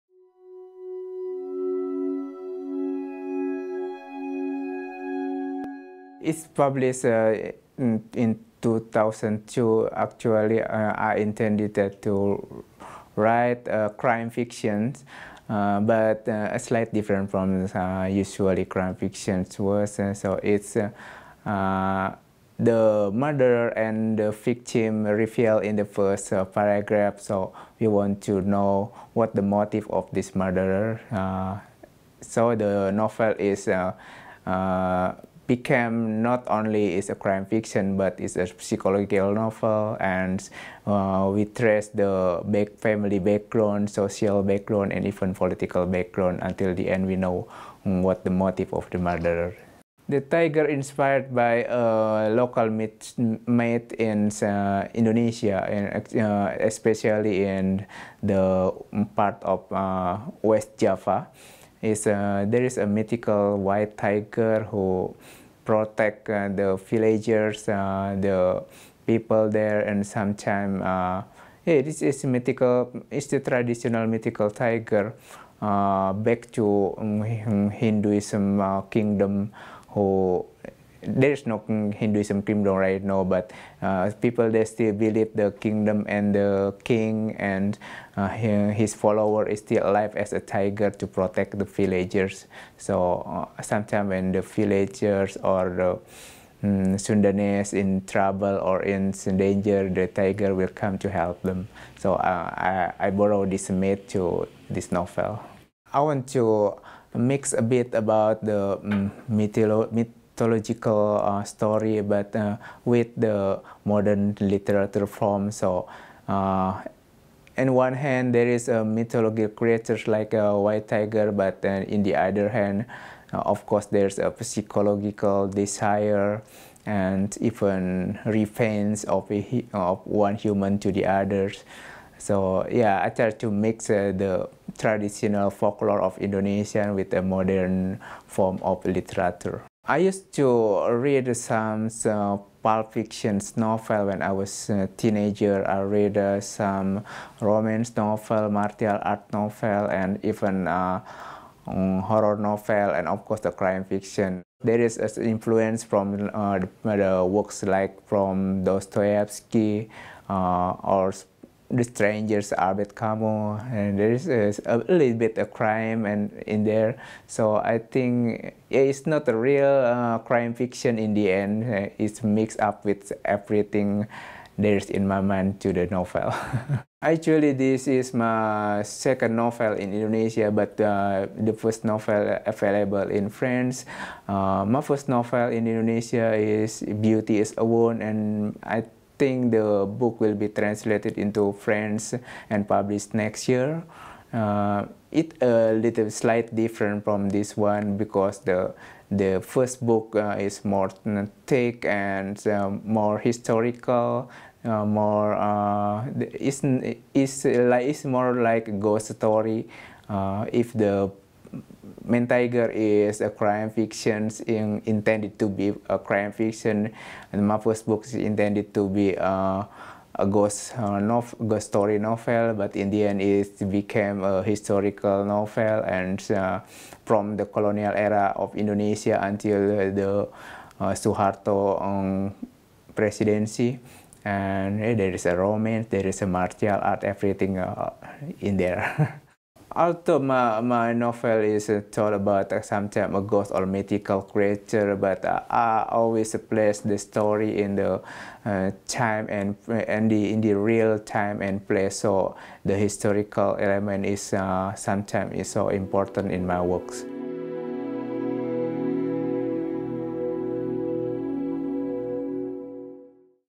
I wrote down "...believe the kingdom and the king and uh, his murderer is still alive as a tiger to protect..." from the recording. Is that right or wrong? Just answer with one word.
wrong.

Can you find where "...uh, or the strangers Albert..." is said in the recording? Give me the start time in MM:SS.
02:40.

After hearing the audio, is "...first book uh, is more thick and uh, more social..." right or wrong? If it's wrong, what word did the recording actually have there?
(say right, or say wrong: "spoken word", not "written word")
wrong: "historical", not "social".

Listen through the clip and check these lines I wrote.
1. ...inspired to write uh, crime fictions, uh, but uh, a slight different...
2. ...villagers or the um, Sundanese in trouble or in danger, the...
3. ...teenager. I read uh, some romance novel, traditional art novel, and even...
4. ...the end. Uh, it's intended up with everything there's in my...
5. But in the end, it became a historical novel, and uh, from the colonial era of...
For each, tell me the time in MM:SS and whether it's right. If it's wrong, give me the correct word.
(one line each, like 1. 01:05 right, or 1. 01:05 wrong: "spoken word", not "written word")
1. 00:11 wrong: "intended", not "inspired"
2. 01:34 right
3. 02:24 wrong: "martial", not "traditional"
4. 02:51 wrong: "mixed", not "intended"
5. 03:42 right.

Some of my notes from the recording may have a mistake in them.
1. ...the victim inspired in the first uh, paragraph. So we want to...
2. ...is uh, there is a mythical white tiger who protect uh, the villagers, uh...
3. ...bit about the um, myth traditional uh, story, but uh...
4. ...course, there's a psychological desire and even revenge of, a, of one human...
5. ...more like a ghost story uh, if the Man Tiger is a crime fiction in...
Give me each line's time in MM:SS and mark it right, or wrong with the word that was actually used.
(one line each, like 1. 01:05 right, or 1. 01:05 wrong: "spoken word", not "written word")
1. 00:24 wrong: "revealed", not "inspired"
2. 01:01 right
3. 01:47 wrong: "mythological", not "traditional"
4. 02:03 right
5. 03:28 right.